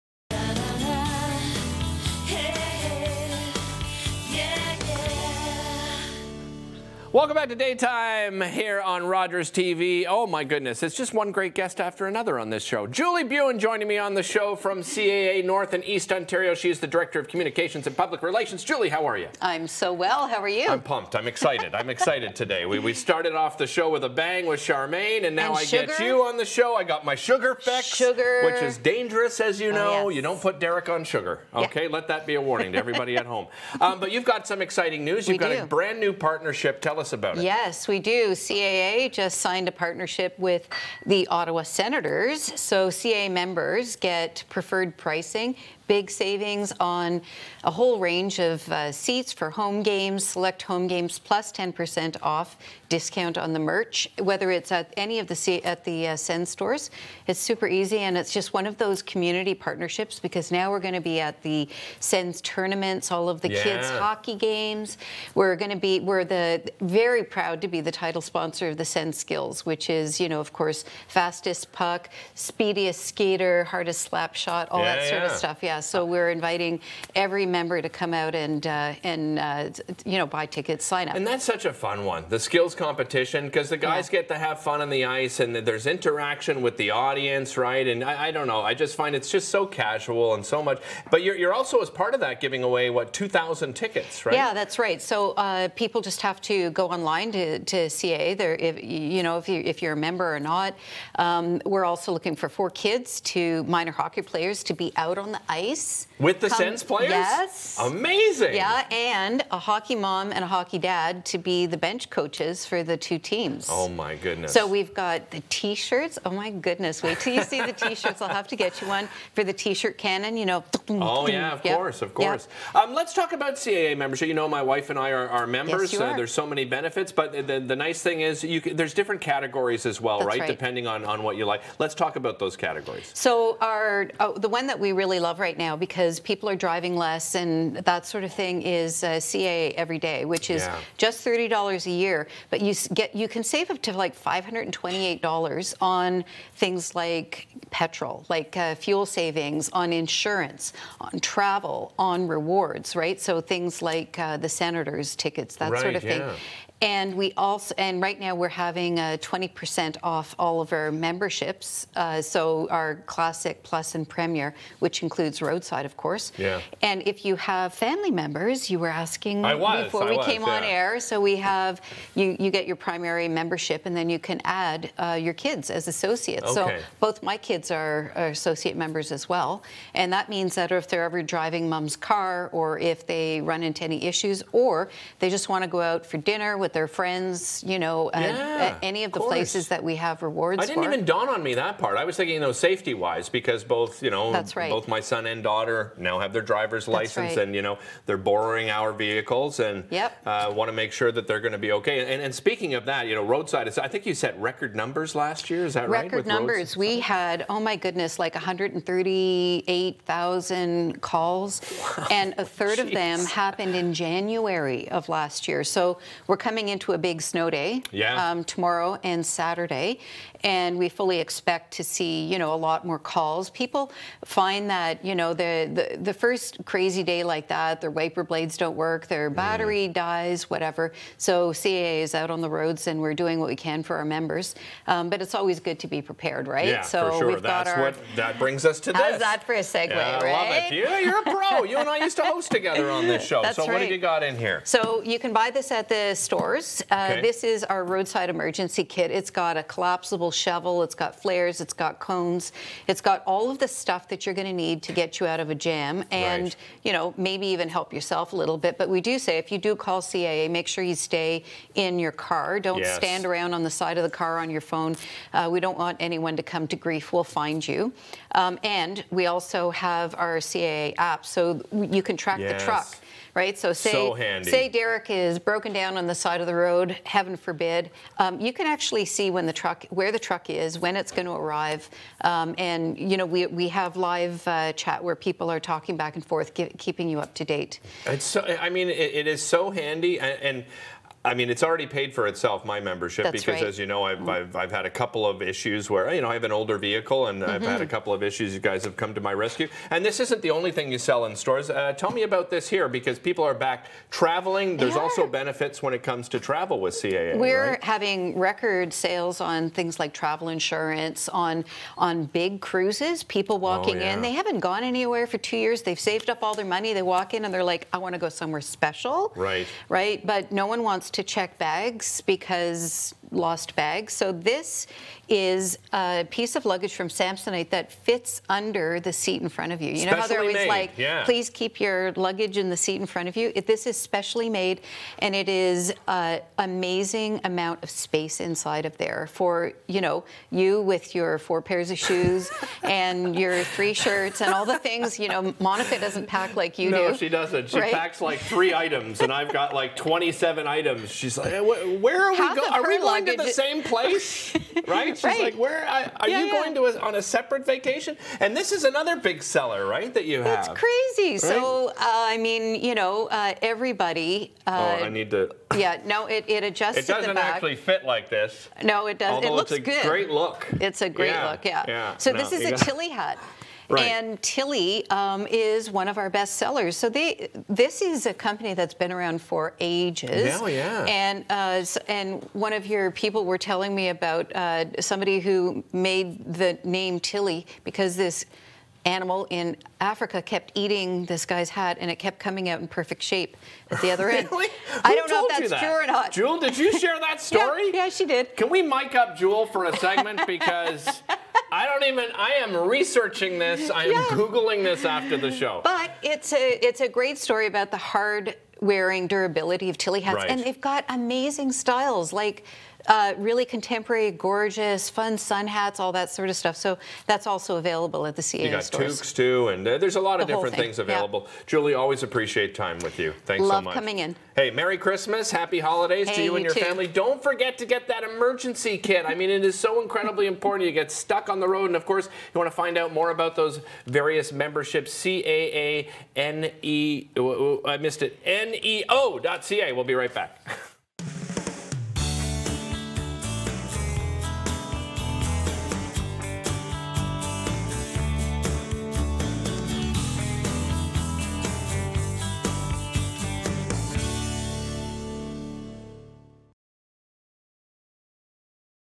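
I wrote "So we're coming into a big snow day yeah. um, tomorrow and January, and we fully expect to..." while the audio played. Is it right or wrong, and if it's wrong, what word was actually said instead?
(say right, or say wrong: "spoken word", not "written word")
wrong: "Saturday", not "January".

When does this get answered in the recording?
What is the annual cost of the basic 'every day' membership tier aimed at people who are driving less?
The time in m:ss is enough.
2:21.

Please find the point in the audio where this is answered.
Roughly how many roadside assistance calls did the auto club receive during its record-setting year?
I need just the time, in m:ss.
3:28.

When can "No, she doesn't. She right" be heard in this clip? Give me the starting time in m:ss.
5:47.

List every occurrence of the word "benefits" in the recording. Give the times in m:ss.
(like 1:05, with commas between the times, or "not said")
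2:06, 5:05.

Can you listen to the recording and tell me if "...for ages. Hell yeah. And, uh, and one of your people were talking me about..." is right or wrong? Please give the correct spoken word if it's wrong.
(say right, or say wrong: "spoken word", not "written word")
wrong: "telling", not "talking".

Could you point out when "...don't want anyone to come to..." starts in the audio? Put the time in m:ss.
4:25.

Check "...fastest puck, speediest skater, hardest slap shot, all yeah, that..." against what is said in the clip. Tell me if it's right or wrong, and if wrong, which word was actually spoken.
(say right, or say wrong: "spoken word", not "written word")
right.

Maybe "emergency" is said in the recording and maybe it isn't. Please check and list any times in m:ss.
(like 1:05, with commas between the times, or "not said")
4:08, 7:08.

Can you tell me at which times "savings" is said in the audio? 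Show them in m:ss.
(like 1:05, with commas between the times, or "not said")
0:46, 2:29.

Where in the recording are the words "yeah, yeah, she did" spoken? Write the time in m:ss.
6:37.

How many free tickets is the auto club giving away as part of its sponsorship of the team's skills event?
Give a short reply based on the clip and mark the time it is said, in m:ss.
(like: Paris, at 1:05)
2,000, at 1:33.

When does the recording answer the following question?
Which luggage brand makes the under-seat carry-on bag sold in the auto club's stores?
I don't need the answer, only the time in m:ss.
5:27.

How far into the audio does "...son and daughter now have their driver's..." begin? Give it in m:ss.
3:15.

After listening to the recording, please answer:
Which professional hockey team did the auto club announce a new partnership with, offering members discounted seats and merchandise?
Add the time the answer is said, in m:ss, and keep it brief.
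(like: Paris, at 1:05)
Ottawa Senators, at 0:41.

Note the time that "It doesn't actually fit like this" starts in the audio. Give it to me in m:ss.
6:06.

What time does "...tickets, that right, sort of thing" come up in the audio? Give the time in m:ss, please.
2:35.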